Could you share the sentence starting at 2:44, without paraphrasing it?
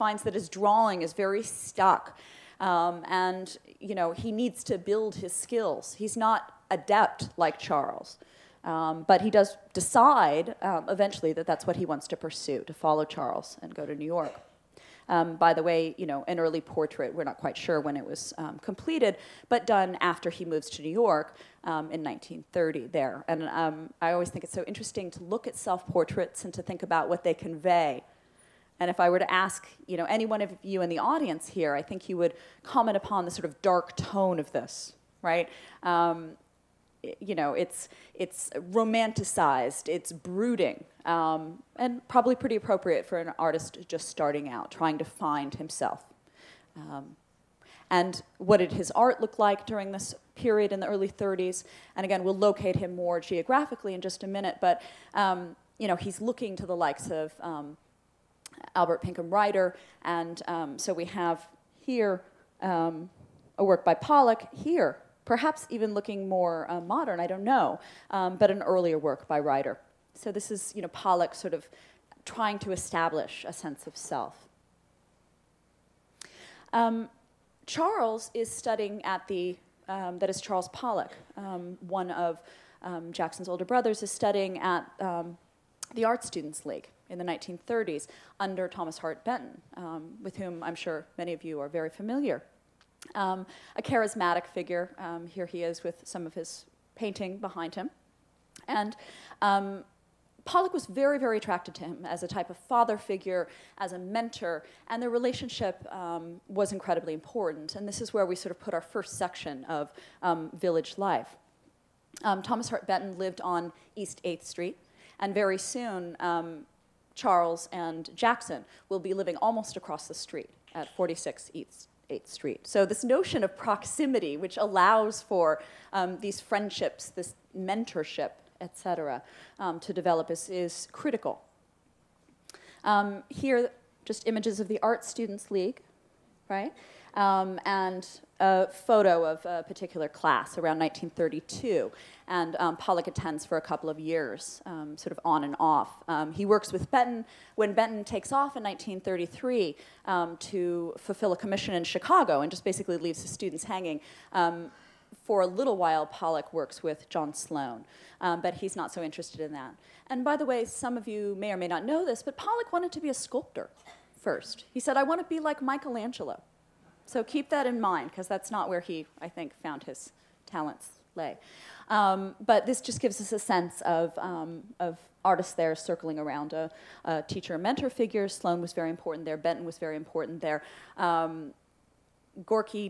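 He said, I want to be like Michelangelo.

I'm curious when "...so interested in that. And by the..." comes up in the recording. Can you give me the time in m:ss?
2:38.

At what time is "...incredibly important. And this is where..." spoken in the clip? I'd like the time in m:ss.
1:46.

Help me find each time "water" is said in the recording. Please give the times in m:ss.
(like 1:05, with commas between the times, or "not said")
not said.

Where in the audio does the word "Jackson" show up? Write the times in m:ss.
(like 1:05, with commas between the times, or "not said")
1:23, 1:58.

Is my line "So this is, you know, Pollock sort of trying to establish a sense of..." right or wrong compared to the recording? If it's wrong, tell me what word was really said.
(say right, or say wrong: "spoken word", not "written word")
right.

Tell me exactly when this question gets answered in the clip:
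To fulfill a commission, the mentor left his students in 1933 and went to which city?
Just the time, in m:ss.
2:31.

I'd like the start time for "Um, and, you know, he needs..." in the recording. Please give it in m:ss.
0:02.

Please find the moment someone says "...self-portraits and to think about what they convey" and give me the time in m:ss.
0:25.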